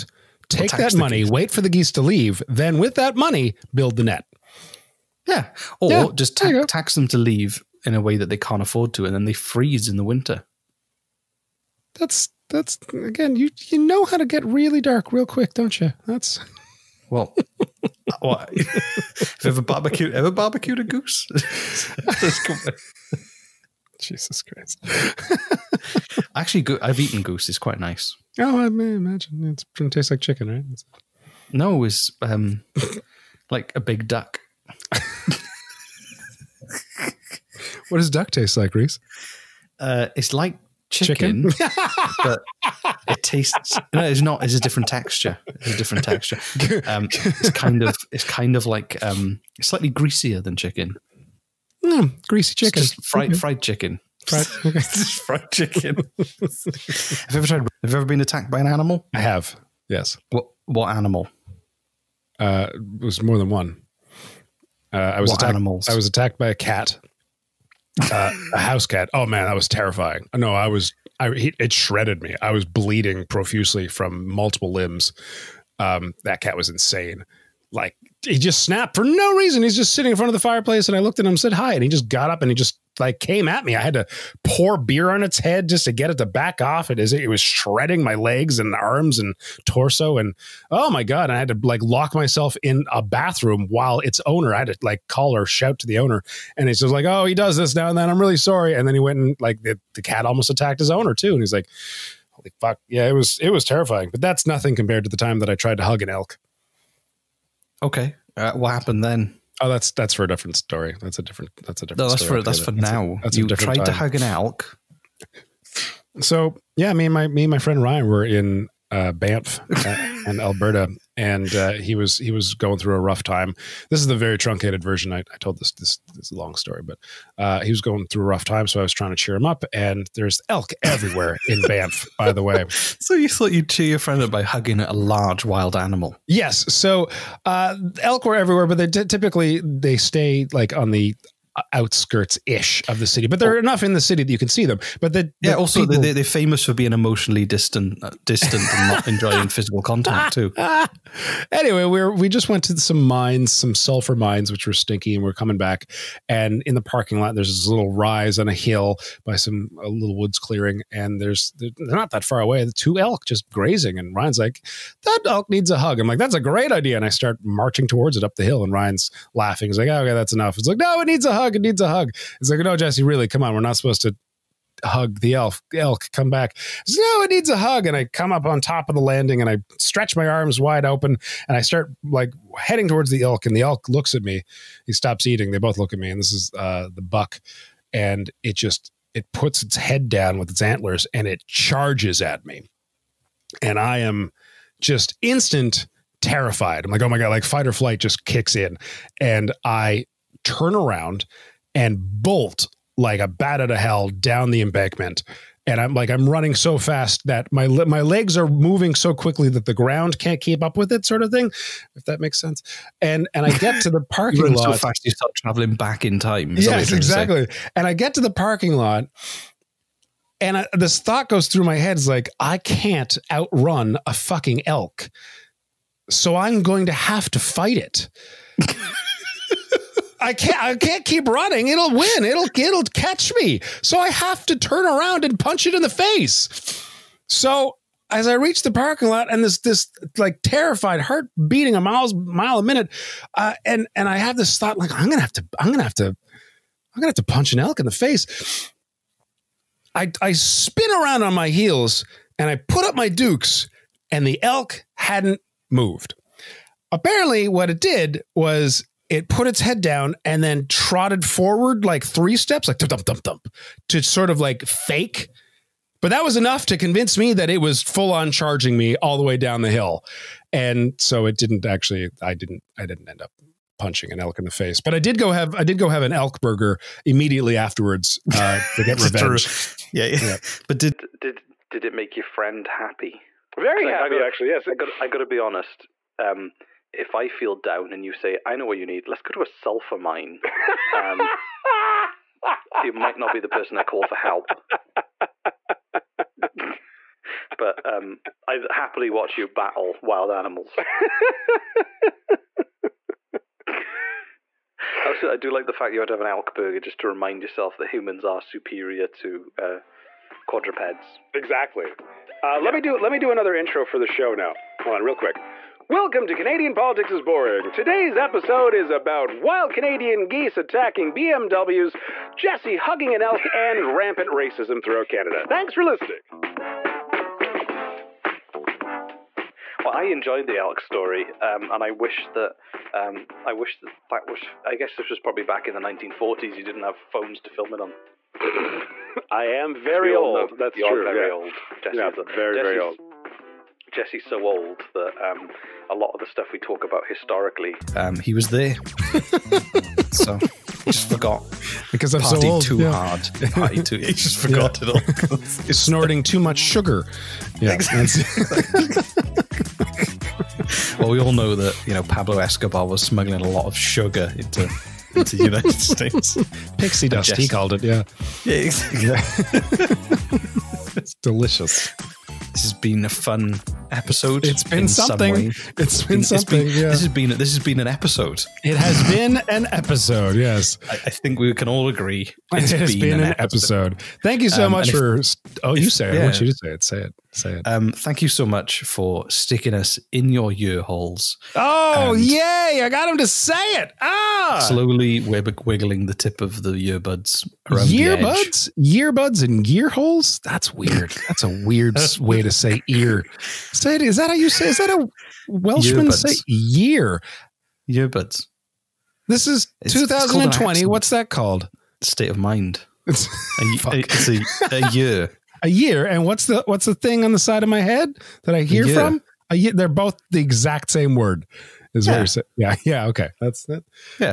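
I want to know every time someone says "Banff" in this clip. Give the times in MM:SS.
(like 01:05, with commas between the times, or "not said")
01:59, 02:11.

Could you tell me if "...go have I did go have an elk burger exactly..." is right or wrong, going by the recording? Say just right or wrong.
wrong.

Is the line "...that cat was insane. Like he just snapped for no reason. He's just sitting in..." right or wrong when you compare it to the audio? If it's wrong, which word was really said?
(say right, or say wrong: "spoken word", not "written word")
right.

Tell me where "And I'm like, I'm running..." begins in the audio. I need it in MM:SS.
03:25.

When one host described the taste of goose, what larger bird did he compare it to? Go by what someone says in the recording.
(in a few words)
a big duck.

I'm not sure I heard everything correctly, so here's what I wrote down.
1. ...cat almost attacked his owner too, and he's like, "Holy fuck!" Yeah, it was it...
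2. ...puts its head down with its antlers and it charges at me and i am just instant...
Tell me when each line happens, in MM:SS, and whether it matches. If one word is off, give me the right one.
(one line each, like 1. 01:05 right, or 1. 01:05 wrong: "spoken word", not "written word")
1. 01:40 right
2. 03:09 right.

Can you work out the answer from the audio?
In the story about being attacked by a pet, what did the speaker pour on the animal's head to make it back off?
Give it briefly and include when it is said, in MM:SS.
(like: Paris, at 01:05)
beer, at 01:23.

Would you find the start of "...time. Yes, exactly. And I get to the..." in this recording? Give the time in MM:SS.
03:36.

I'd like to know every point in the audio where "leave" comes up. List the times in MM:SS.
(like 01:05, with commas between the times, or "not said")
00:02, 00:07.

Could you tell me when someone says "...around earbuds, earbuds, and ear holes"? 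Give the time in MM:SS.
06:37.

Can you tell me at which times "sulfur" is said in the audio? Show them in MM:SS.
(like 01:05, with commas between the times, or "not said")
02:33, 04:49.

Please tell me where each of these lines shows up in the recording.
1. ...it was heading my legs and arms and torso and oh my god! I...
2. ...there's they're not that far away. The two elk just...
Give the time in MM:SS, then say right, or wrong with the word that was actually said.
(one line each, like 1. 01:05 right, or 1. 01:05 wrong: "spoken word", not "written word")
1. 01:27 wrong: "shredding", not "heading"
2. 02:41 right.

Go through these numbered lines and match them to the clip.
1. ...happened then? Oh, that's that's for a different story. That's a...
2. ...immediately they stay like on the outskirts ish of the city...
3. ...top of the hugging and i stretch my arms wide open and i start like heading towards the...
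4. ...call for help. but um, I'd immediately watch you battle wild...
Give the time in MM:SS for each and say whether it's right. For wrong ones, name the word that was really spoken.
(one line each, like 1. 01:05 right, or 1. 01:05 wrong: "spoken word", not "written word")
1. 01:48 right
2. 02:18 wrong: "typically", not "immediately"
3. 02:58 wrong: "landing", not "hugging"
4. 04:53 wrong: "happily", not "immediately".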